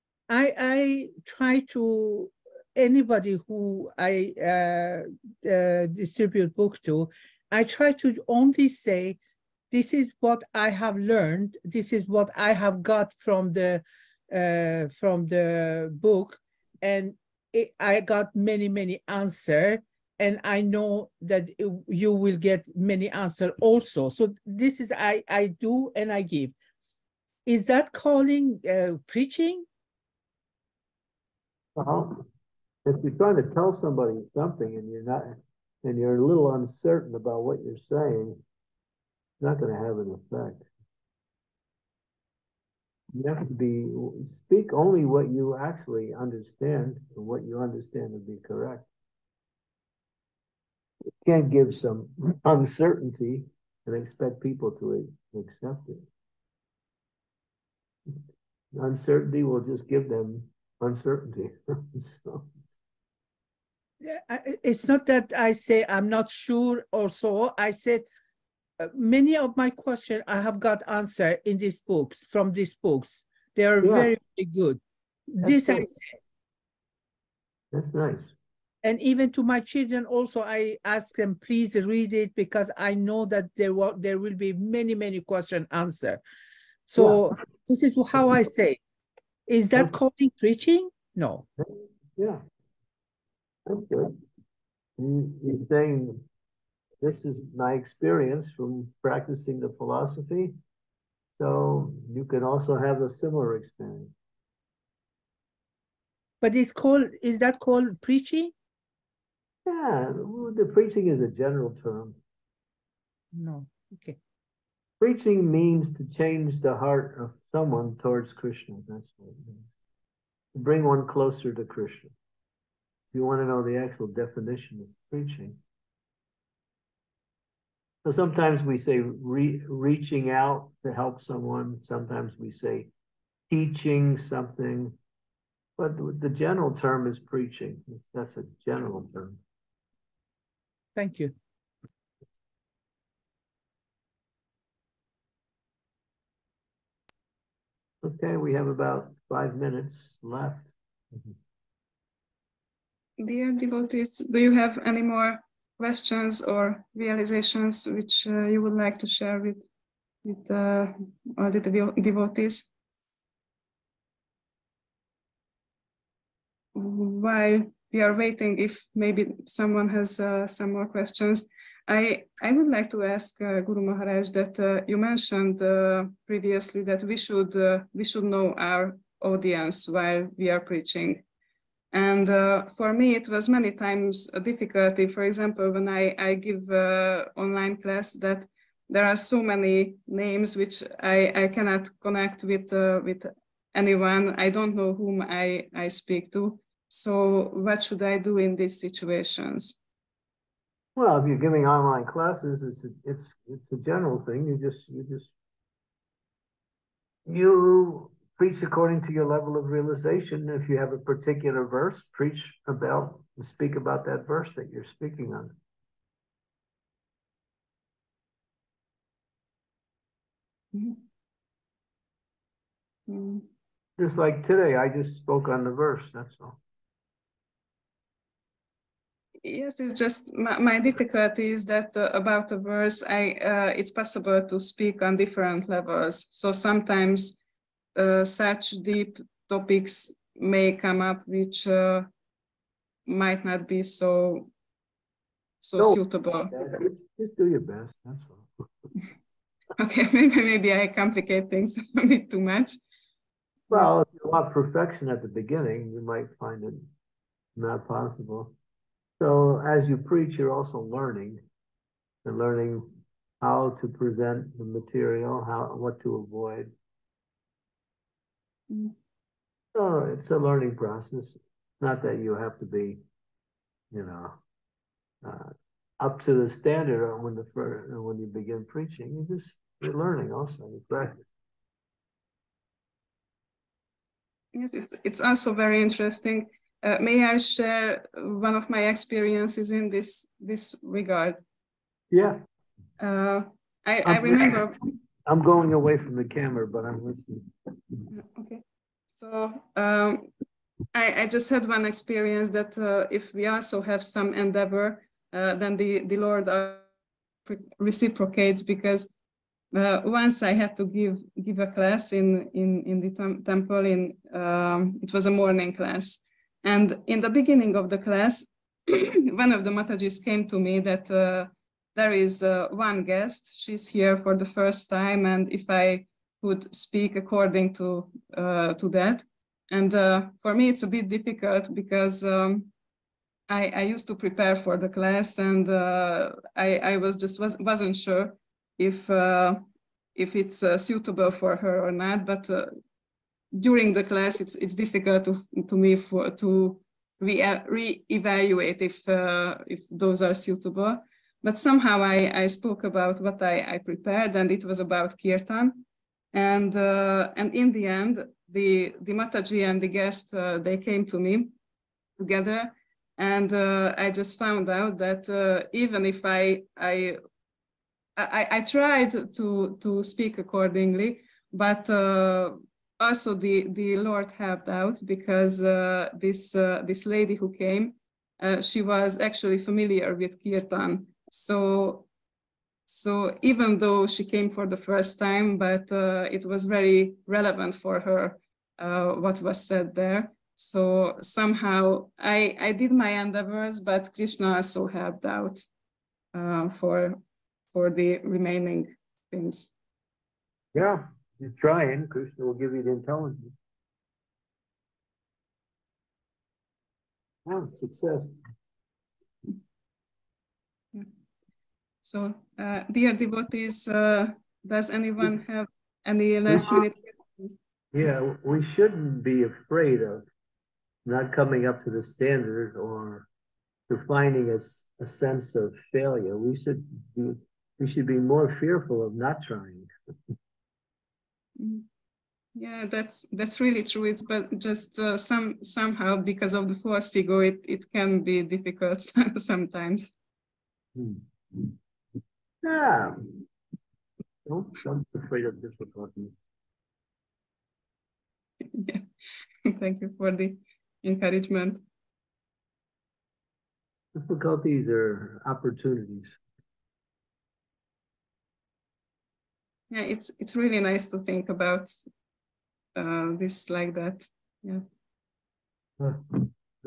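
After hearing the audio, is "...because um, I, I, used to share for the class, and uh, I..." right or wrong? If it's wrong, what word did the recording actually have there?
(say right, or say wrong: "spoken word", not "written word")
wrong: "prepare", not "share".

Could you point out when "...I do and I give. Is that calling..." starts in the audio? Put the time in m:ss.
0:25.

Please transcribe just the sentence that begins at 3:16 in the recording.
So what should I do in these situations?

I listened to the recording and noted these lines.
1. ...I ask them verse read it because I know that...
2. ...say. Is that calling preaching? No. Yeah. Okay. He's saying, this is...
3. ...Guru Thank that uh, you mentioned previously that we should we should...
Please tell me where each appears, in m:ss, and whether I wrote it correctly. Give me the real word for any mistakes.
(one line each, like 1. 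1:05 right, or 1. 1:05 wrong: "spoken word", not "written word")
1. 1:20 wrong: "please", not "verse"
2. 1:28 right
3. 2:53 wrong: "Maharaj", not "Thank".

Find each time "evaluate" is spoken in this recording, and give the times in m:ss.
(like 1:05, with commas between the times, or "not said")
5:47.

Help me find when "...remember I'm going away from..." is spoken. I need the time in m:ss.
4:54.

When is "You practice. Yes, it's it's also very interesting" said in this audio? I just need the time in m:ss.
4:40.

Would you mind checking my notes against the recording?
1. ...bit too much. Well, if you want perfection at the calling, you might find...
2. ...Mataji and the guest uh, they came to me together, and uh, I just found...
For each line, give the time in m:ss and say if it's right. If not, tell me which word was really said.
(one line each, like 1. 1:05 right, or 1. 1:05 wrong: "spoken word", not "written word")
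1. 4:12 wrong: "beginning", not "calling"
2. 5:59 right.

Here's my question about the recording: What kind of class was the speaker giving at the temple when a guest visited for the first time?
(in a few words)
Morning class.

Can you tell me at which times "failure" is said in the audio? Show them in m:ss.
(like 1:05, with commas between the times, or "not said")
7:05.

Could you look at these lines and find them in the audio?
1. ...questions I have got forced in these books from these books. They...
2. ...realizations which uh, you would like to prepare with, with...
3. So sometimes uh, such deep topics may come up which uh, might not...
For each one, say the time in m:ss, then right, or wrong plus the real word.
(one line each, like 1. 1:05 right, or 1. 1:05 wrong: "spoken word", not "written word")
1. 1:09 wrong: "answered", not "forced"
2. 2:36 wrong: "share", not "prepare"
3. 3:56 right.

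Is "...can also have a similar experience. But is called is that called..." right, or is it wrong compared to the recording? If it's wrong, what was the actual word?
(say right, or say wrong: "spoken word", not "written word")
right.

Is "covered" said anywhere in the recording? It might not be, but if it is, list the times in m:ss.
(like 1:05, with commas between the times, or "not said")
not said.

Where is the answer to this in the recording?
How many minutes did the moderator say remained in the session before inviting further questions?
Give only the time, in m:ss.
2:29.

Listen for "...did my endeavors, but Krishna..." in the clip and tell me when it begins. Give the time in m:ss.
6:32.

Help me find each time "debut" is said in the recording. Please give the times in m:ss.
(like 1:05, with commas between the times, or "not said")
not said.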